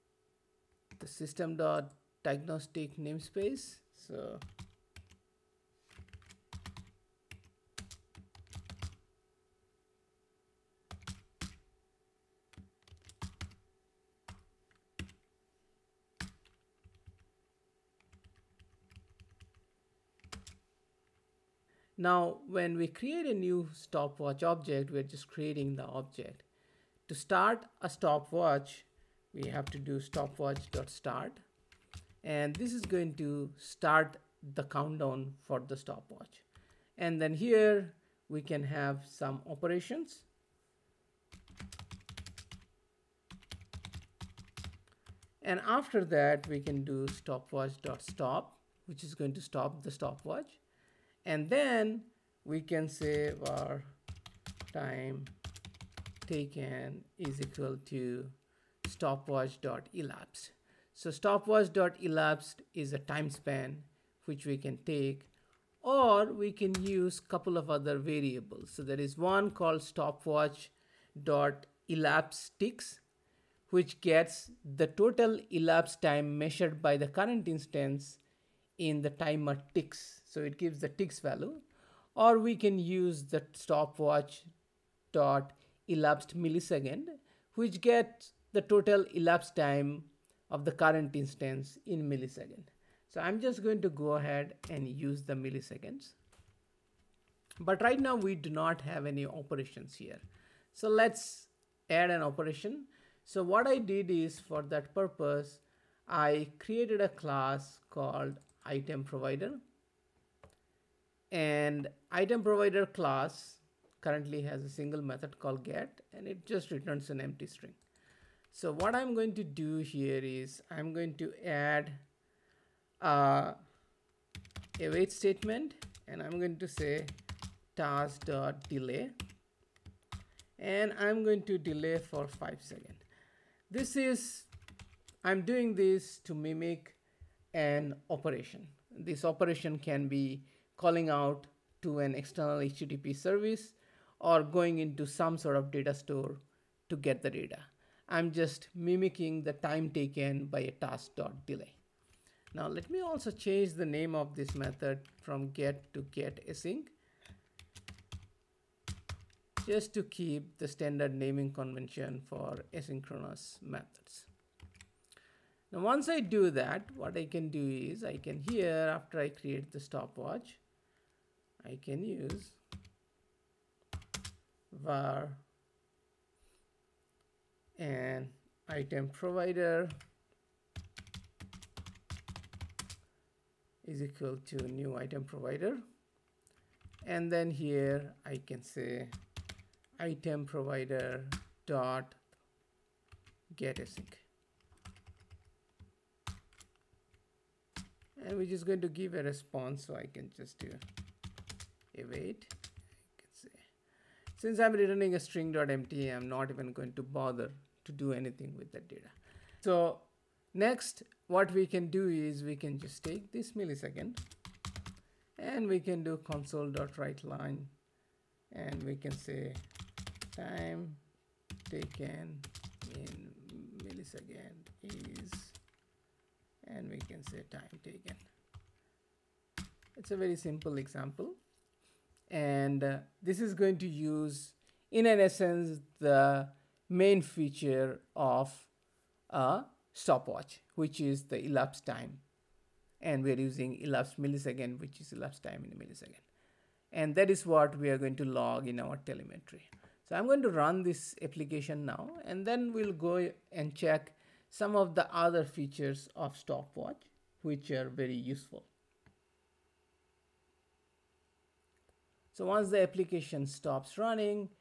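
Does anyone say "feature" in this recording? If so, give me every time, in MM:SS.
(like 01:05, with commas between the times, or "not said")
03:57, 04:15.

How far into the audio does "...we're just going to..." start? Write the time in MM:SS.
03:18.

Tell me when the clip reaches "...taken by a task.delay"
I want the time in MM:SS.
02:29.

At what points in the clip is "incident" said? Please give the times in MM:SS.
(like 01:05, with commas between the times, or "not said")
not said.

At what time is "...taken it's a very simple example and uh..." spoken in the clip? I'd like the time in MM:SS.
03:47.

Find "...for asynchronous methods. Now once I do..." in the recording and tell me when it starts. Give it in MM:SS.
02:42.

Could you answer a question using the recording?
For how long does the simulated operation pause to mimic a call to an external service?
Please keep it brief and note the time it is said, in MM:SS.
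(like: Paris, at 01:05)
5 seconds, at 02:12.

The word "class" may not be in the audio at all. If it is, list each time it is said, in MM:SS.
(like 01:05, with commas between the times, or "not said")
01:47, 01:52.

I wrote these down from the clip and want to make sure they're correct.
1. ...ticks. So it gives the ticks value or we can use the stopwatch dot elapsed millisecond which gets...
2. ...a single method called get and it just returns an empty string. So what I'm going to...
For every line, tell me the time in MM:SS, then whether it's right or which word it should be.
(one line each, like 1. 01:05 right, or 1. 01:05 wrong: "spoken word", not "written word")
1. 01:19 right
2. 01:54 right.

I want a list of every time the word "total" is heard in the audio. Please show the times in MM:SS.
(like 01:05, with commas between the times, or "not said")
01:14, 01:28.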